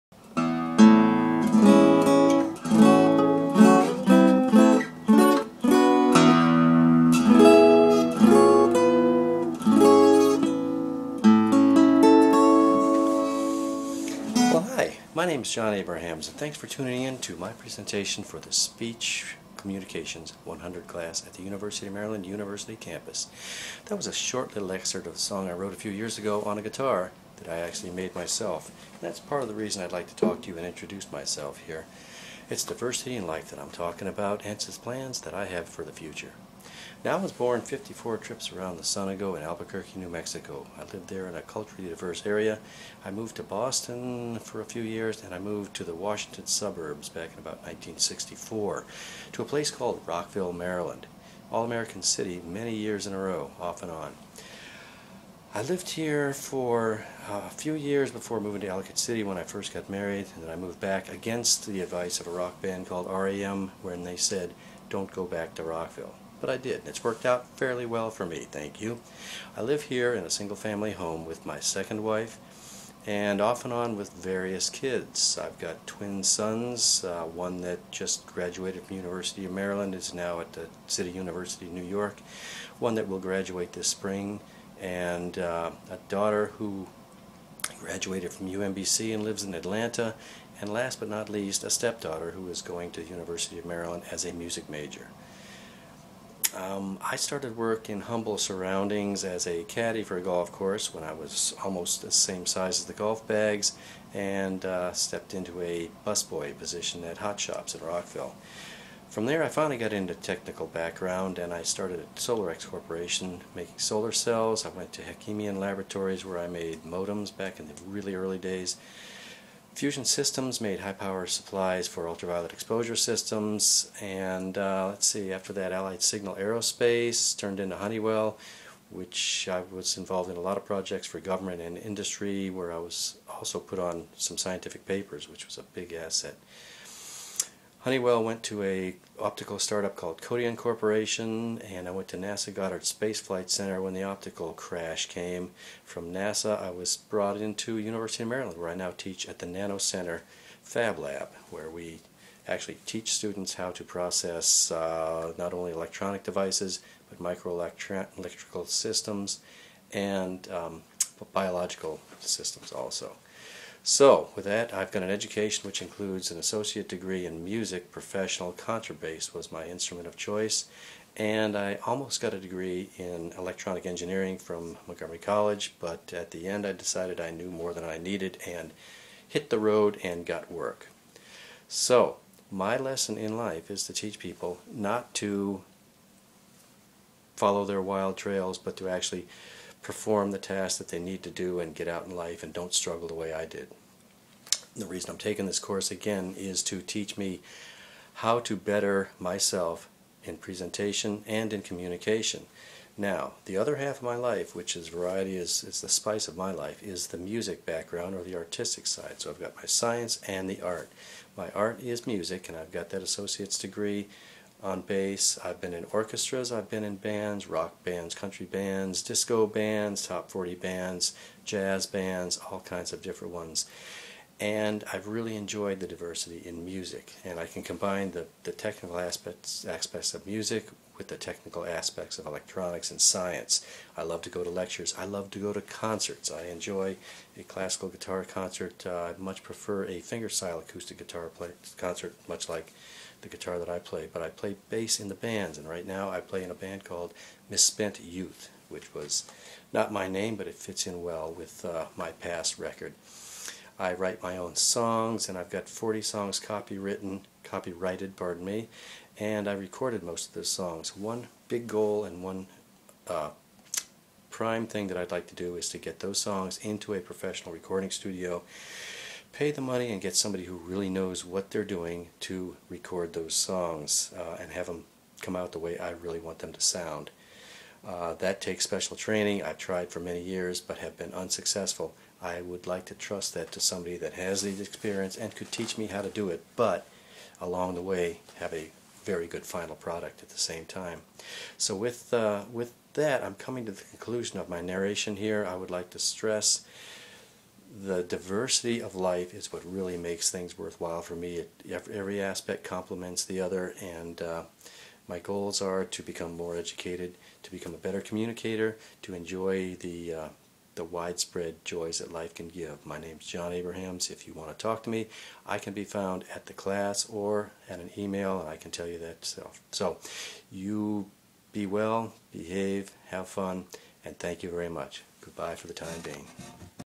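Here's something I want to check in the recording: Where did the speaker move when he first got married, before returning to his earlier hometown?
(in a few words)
Ellicott City.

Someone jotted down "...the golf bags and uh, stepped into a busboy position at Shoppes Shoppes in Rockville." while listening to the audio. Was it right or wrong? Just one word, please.
wrong.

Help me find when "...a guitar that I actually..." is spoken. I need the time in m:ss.
0:26.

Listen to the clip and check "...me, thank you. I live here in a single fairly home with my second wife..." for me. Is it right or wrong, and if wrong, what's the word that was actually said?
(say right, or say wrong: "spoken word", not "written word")
wrong: "family", not "fairly".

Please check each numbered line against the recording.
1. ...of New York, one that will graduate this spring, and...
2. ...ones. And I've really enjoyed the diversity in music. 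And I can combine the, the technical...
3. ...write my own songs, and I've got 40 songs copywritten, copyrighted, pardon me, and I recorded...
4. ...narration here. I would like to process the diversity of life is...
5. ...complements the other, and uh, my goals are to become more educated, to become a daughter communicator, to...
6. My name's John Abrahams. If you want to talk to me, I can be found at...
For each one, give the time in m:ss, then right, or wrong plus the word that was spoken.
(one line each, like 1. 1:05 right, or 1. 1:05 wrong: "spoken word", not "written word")
1. 1:21 right
2. 3:43 right
3. 4:13 right
4. 4:54 wrong: "stress", not "process"
5. 5:02 wrong: "better", not "daughter"
6. 5:12 right.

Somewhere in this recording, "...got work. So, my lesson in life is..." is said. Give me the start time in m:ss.
3:00.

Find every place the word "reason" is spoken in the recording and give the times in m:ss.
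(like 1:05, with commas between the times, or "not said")
0:29, 3:14.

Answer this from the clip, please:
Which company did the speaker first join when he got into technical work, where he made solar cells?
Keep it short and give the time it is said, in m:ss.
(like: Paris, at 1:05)
Solarex Corporation, at 1:52.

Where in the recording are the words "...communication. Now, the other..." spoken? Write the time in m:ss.
3:21.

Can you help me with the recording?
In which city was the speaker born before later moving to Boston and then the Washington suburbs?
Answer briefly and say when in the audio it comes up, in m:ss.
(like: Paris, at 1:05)
Albuquerque, New Mexico, at 0:39.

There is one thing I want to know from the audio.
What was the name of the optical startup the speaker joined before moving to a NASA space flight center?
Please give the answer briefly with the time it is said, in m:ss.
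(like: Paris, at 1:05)
Codeon Corporation, at 2:20.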